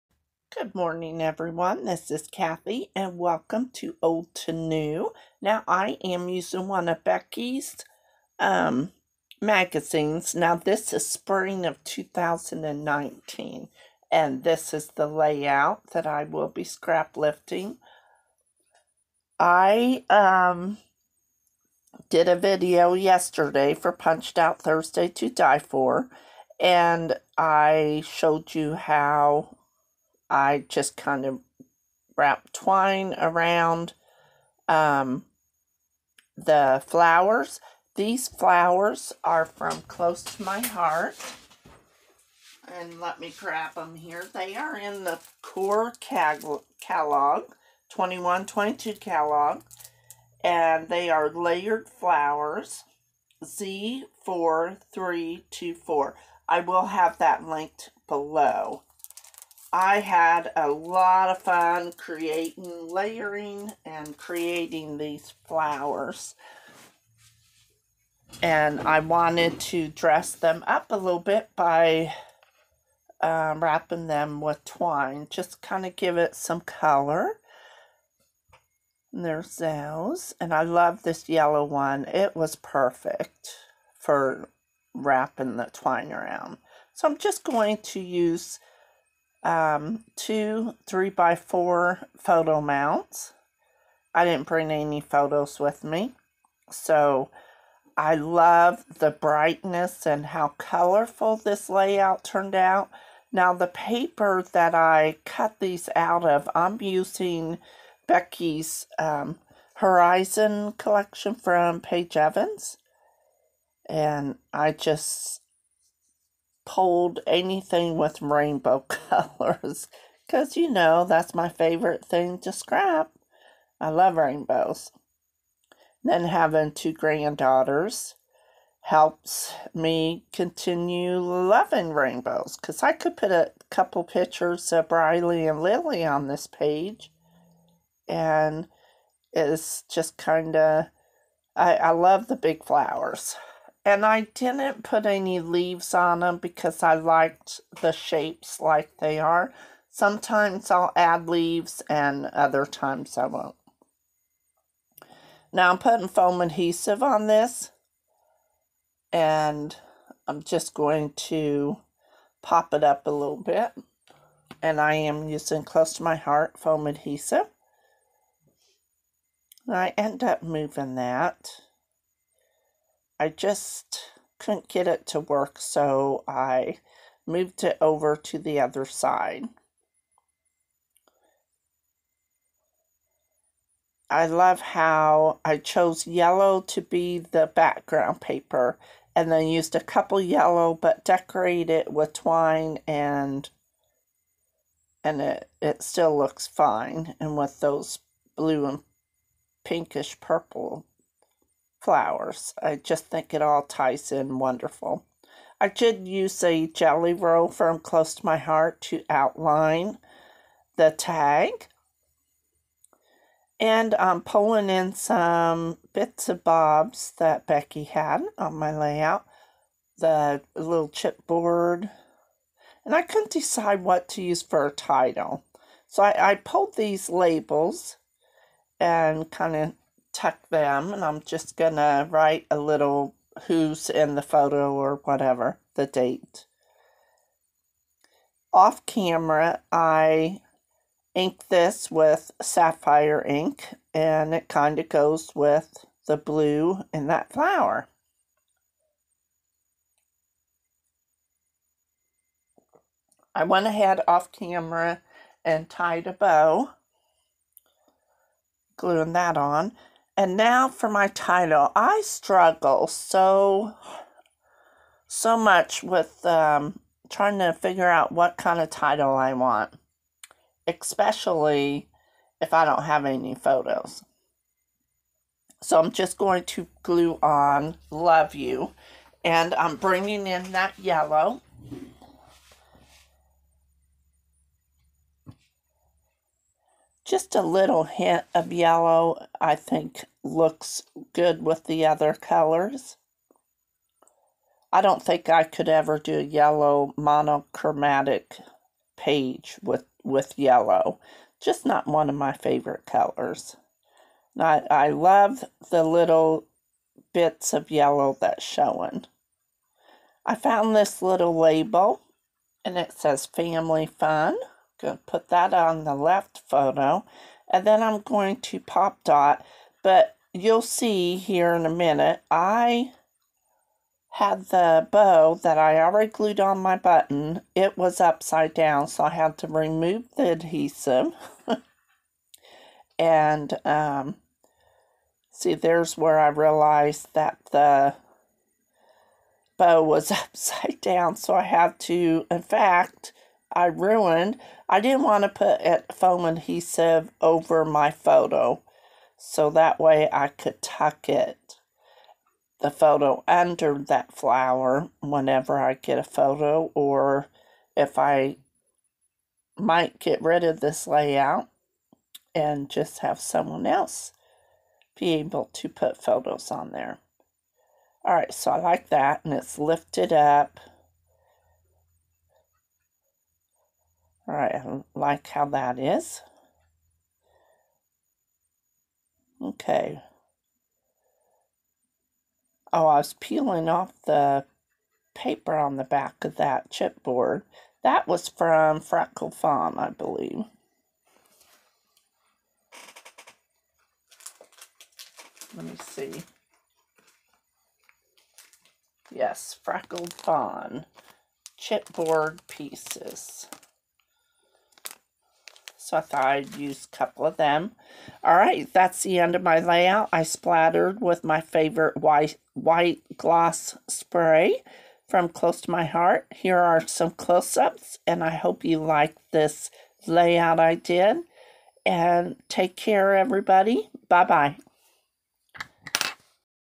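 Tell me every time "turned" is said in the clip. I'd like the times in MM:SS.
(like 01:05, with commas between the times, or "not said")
01:42.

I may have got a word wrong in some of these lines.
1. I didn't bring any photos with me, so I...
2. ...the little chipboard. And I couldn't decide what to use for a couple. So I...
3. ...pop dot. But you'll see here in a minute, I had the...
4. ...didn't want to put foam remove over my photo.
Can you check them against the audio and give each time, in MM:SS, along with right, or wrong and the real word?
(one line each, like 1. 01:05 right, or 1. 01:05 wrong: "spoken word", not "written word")
1. 01:34 right
2. 03:39 wrong: "title", not "couple"
3. 05:18 right
4. 05:44 wrong: "adhesive", not "remove".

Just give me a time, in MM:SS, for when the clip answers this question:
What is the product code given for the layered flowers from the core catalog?
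00:53.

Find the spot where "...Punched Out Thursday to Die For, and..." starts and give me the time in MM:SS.
00:23.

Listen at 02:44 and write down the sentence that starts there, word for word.
And I am using close to my heart foam adhesive.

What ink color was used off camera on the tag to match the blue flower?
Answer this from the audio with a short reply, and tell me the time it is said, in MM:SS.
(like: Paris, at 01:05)
Sapphire, at 04:02.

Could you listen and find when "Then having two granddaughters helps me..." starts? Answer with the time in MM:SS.
02:06.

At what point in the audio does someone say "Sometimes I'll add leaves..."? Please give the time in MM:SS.
02:29.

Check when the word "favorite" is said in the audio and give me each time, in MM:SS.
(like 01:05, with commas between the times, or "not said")
02:01, 05:02, 06:51.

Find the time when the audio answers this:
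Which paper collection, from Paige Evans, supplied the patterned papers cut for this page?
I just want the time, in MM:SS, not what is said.
01:49.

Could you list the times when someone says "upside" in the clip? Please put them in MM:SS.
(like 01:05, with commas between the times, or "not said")
05:28, 05:40.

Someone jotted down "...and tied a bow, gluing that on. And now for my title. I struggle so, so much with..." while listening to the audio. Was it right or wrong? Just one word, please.
right.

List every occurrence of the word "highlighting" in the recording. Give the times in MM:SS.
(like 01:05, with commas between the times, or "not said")
not said.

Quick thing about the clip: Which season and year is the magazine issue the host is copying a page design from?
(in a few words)
Spring 2019.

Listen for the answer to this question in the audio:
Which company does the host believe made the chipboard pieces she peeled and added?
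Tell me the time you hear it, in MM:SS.
06:39.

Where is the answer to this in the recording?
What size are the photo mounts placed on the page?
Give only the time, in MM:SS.
01:30.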